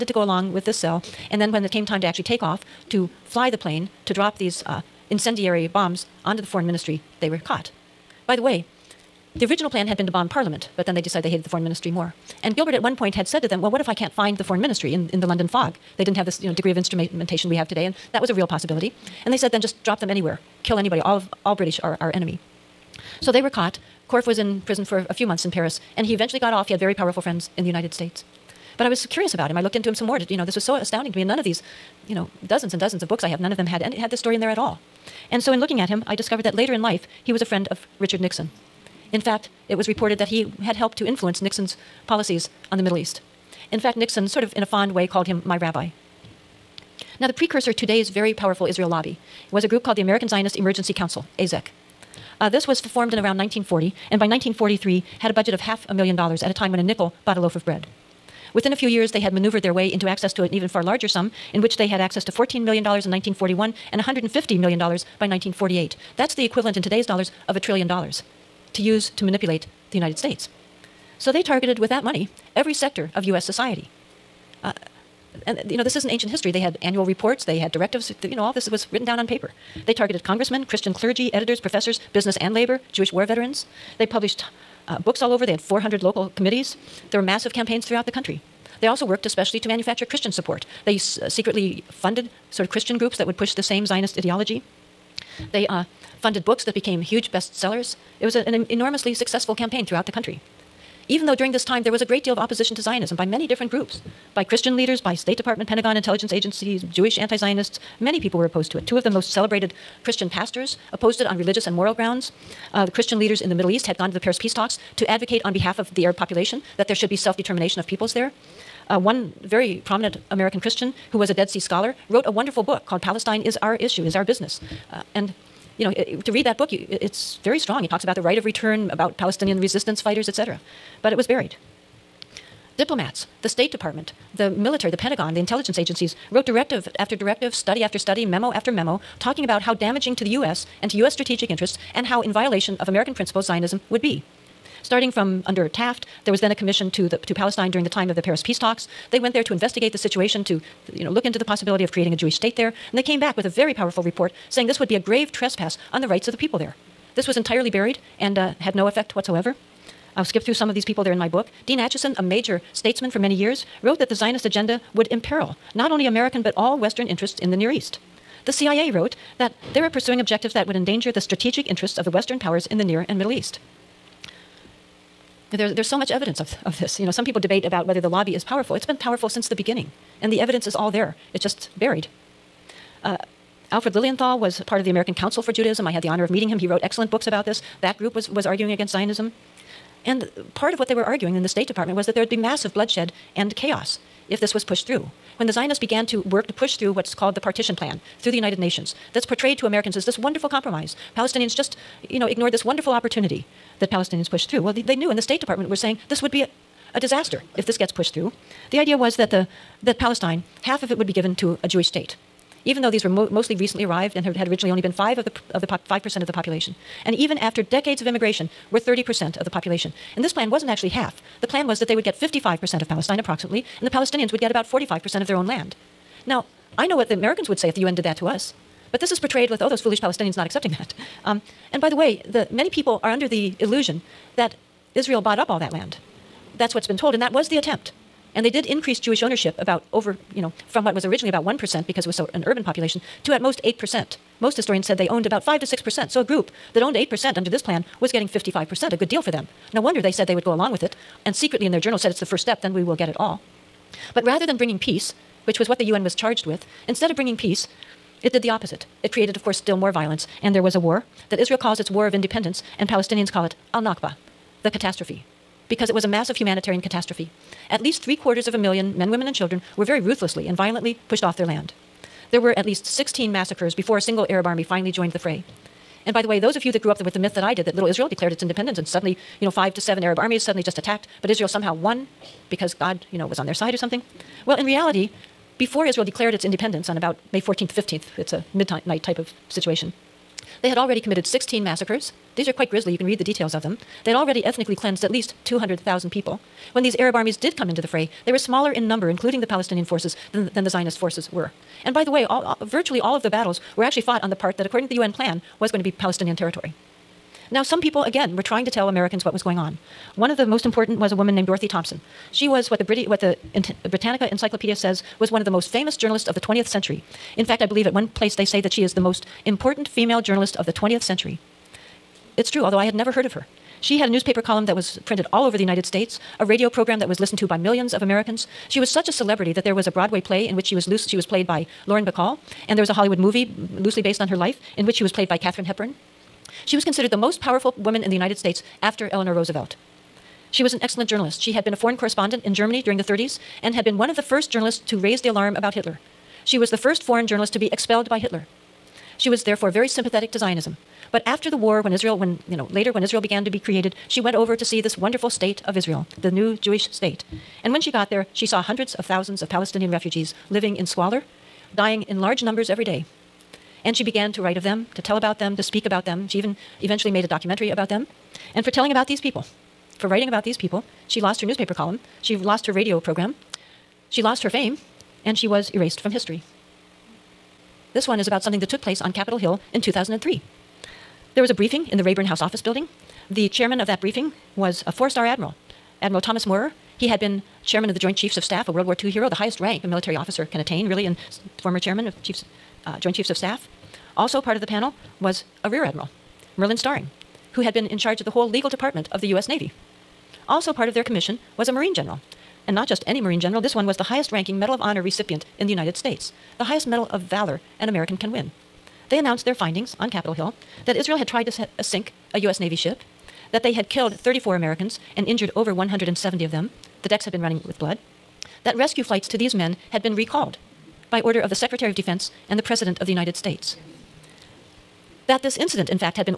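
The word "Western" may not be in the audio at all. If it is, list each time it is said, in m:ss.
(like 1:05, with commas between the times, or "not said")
2:46, 2:52.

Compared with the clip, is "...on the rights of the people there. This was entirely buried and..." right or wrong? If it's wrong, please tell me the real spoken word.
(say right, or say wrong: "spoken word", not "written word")
right.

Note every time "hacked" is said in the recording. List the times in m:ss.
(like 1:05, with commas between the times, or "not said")
not said.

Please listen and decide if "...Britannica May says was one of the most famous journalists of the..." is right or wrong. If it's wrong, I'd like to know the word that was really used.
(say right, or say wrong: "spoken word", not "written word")
wrong: "Encyclopedia", not "May".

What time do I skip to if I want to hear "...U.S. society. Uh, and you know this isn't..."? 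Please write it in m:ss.
1:13.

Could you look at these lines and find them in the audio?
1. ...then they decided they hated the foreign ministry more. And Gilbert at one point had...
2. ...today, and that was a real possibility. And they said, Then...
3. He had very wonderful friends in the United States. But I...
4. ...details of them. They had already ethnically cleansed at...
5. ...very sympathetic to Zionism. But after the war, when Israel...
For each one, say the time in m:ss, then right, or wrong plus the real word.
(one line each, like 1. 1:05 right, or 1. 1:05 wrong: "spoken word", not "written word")
1. 0:10 right
2. 0:17 right
3. 0:26 wrong: "powerful", not "wonderful"
4. 4:53 right
5. 5:49 right.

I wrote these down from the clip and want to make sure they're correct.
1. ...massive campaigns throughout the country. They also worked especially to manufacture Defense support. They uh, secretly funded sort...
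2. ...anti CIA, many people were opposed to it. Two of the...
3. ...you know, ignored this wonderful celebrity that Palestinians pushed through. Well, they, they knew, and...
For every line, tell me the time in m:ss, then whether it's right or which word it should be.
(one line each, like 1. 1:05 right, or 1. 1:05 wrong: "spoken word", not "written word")
1. 1:27 wrong: "Christian", not "Defense"
2. 1:47 wrong: "Zionists", not "CIA"
3. 3:22 wrong: "opportunity", not "celebrity".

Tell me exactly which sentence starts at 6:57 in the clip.
The decks had been running with blood.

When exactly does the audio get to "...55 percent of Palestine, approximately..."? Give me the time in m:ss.
3:42.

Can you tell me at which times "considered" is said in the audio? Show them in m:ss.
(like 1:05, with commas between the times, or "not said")
5:36.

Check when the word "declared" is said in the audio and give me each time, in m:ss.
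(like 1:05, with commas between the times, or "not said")
4:38, 4:46.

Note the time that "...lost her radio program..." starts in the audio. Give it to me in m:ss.
6:12.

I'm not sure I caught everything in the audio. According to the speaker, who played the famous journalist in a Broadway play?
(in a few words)
Lauren Bacall.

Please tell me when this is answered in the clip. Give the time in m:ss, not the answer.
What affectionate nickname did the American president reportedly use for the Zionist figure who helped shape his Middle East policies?
0:45.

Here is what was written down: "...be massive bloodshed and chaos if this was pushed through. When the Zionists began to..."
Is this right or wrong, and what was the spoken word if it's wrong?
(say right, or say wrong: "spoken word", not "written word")
right.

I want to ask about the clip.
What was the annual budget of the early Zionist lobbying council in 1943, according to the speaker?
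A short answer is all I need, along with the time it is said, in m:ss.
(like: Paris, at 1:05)
half a million dollars, at 0:55.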